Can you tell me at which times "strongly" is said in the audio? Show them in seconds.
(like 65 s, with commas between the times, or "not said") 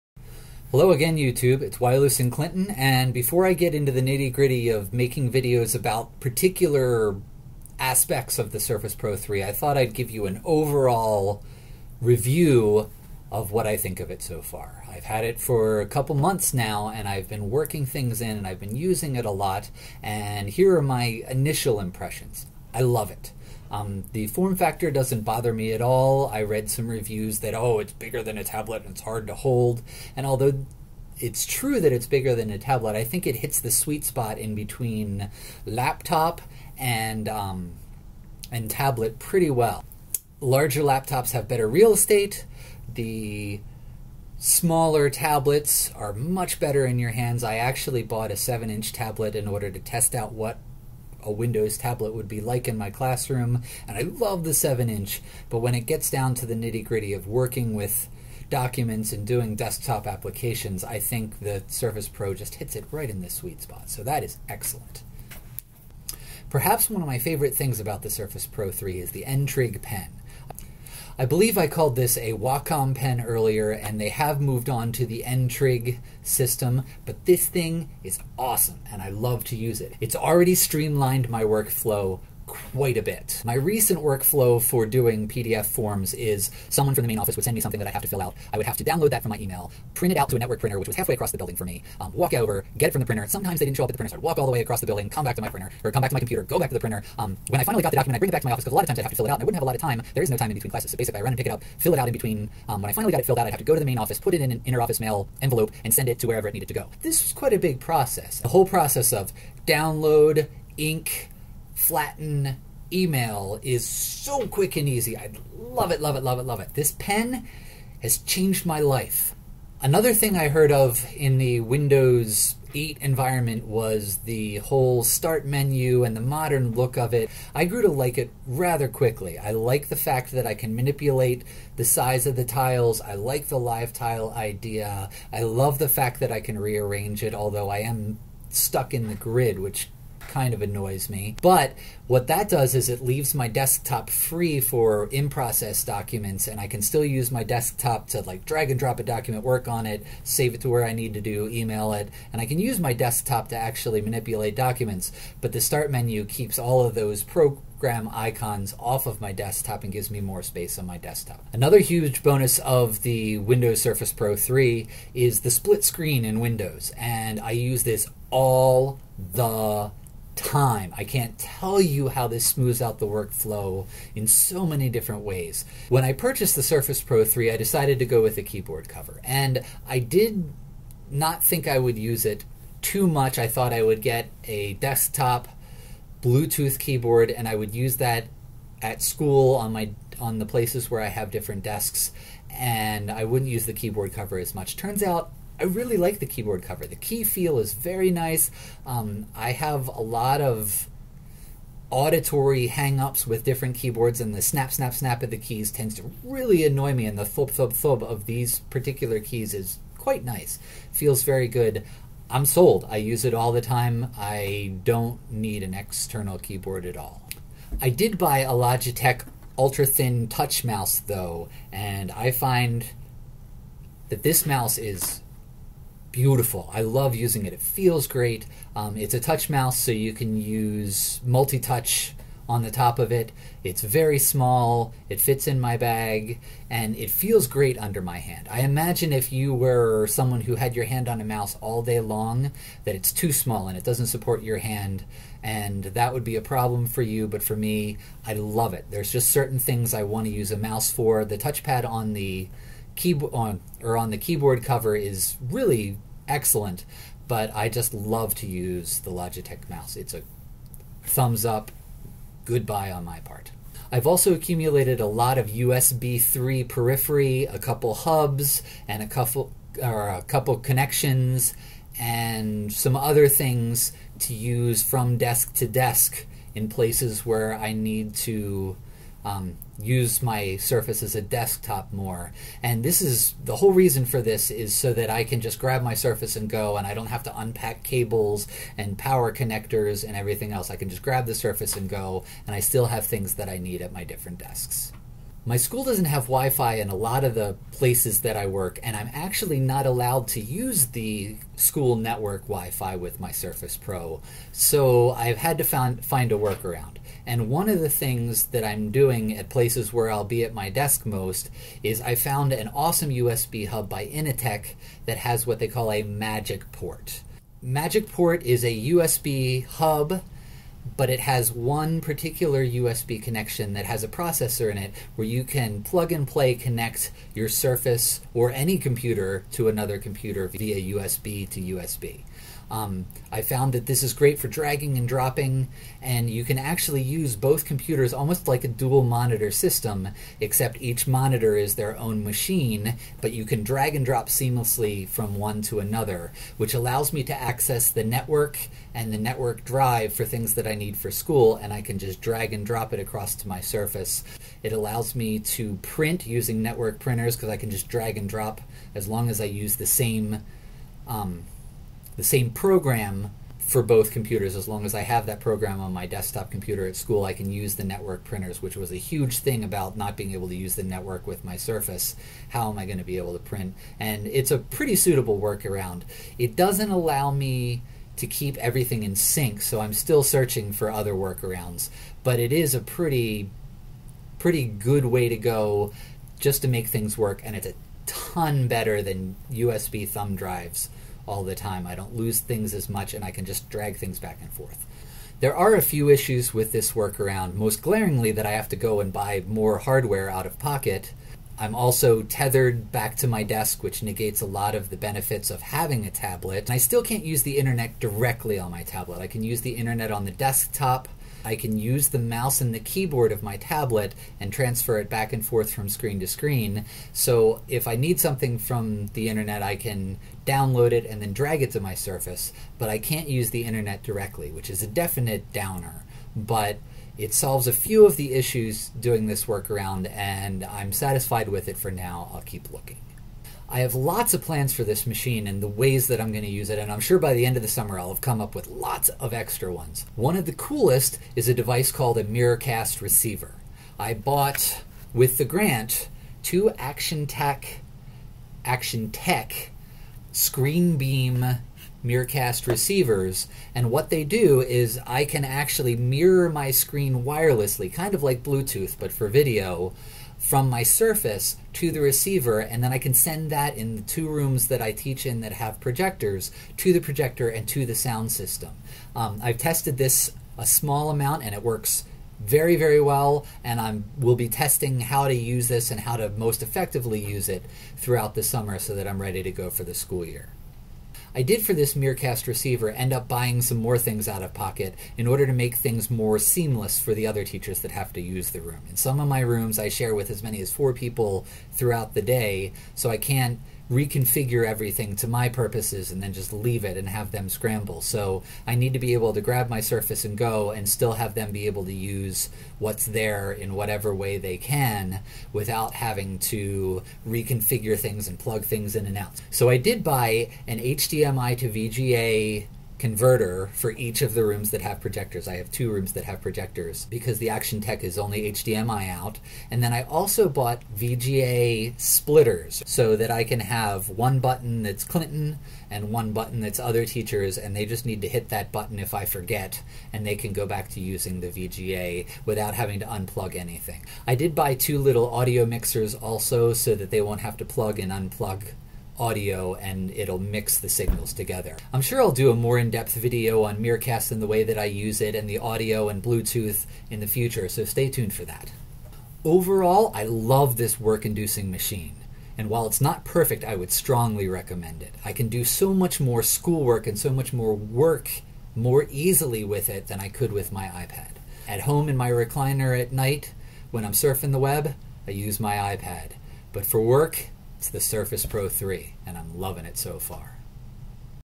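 553 s.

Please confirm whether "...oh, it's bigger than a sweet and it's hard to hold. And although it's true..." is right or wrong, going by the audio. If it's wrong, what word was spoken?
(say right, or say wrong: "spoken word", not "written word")
wrong: "tablet", not "sweet".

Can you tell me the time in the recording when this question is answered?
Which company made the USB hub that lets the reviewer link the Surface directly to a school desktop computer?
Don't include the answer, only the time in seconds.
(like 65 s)
314 s.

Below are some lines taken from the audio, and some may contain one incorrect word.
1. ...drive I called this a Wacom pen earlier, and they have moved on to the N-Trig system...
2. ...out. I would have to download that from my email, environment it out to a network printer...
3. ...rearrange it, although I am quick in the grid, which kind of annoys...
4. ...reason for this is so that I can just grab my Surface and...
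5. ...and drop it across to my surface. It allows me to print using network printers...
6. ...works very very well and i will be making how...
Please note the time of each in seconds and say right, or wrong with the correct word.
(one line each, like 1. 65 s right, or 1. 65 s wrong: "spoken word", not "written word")
1. 71 s wrong: "believe", not "drive"
2. 88 s wrong: "print", not "environment"
3. 136 s wrong: "stuck", not "quick"
4. 283 s right
5. 352 s right
6. 471 s wrong: "testing", not "making".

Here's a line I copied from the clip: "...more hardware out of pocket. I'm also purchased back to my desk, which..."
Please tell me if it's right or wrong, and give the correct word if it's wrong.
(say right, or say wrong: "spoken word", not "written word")
wrong: "tethered", not "purchased".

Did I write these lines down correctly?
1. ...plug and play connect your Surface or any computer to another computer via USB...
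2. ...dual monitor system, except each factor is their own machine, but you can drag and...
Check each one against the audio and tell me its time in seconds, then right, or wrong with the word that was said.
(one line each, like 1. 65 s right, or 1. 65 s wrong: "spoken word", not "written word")
1. 325 s right
2. 338 s wrong: "monitor", not "factor".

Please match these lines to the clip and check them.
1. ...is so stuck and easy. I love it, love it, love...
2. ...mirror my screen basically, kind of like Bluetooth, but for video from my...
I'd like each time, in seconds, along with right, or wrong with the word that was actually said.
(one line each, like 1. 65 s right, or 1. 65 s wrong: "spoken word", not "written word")
1. 113 s wrong: "quick", not "stuck"
2. 455 s wrong: "wirelessly", not "basically".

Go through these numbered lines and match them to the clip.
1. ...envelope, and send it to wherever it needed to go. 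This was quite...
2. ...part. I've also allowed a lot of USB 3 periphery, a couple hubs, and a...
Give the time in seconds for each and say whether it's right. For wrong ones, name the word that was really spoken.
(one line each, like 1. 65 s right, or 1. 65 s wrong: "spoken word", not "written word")
1. 105 s right
2. 263 s wrong: "accumulated", not "allowed".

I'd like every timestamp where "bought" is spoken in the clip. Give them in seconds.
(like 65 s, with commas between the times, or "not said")
48 s, 444 s, 520 s.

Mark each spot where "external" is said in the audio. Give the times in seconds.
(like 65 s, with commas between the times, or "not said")
215 s.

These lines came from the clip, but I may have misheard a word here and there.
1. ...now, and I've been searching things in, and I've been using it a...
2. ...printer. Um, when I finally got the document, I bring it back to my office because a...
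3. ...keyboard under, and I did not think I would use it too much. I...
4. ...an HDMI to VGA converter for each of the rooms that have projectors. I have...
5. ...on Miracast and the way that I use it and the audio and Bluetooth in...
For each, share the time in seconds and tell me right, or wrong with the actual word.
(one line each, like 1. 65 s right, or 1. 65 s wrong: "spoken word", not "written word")
1. 16 s wrong: "working", not "searching"
2. 96 s right
3. 178 s wrong: "cover", not "under"
4. 510 s right
5. 543 s right.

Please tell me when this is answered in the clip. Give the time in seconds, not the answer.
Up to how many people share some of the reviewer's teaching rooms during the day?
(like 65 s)
490 s.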